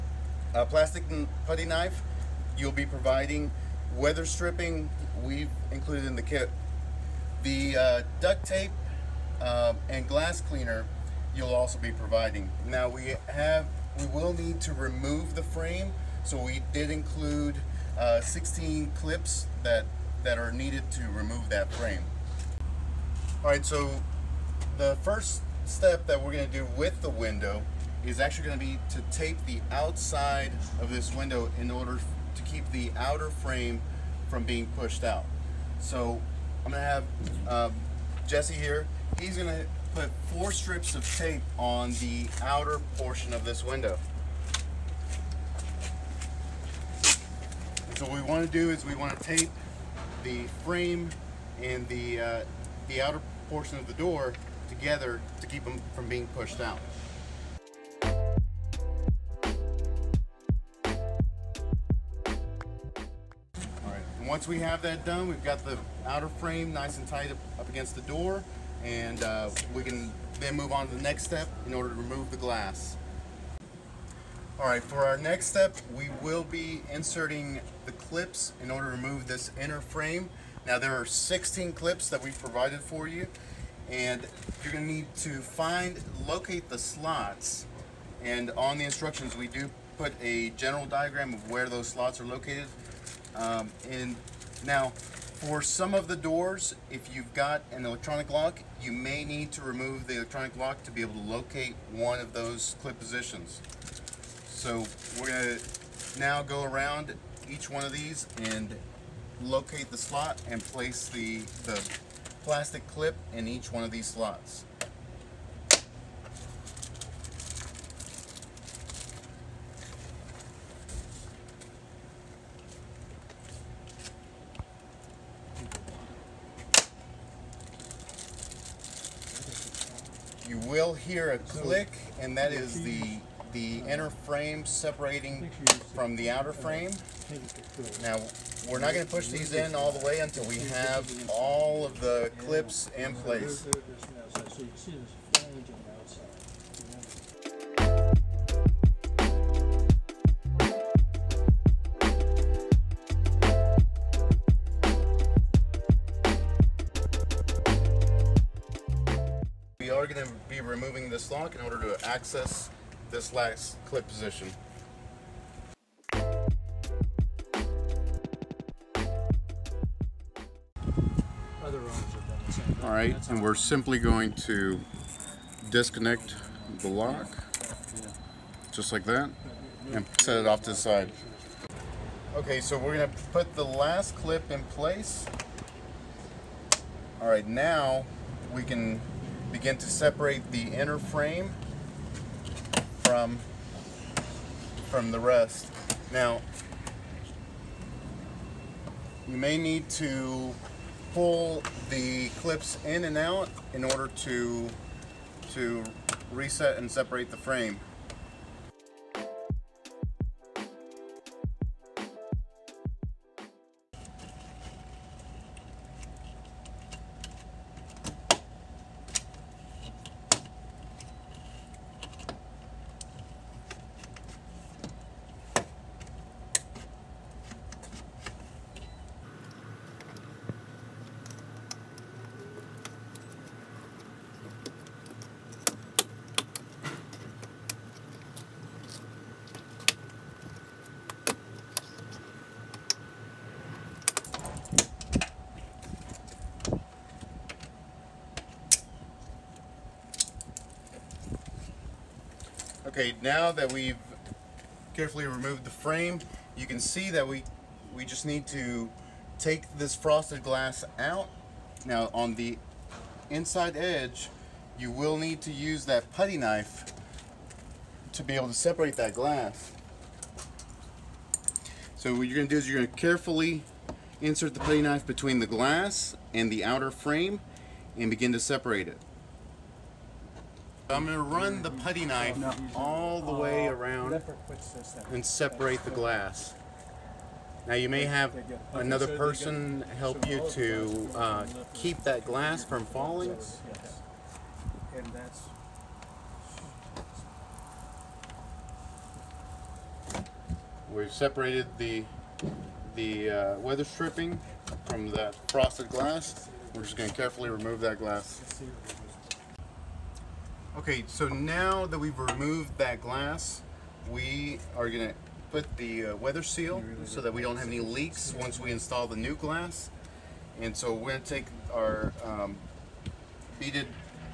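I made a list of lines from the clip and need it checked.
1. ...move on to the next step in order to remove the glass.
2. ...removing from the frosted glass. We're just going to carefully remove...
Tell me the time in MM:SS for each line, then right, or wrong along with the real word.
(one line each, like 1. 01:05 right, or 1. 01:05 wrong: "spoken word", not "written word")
1. 01:10 right
2. 05:03 wrong: "stripping", not "removing".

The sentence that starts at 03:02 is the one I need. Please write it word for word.
Okay, so we're gonna put the last clip in place.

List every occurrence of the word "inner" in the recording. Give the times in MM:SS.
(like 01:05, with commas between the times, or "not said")
01:19, 02:13, 03:10.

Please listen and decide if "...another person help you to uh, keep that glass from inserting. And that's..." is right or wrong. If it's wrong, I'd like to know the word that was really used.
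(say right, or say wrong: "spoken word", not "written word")
wrong: "falling", not "inserting".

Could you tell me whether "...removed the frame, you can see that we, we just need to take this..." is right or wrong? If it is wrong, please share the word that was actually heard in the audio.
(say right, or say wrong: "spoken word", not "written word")
right.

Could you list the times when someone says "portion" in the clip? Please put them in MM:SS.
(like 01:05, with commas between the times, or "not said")
00:42, 00:53.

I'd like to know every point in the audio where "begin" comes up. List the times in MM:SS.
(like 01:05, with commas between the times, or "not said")
03:09, 04:38.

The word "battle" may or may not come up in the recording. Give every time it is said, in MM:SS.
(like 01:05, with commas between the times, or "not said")
not said.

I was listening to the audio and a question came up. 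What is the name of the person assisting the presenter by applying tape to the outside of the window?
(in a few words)
Jesse.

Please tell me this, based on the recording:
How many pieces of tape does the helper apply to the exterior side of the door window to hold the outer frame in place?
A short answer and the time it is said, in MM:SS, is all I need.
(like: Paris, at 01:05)
4, at 00:40.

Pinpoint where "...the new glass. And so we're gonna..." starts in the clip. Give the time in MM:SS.
05:19.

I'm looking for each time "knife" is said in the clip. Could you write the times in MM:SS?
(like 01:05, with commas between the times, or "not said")
00:01, 04:26, 04:34, 04:42.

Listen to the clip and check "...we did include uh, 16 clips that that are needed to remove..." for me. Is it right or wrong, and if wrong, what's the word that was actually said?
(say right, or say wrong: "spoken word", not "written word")
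right.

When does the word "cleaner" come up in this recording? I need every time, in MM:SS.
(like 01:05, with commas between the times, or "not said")
00:10.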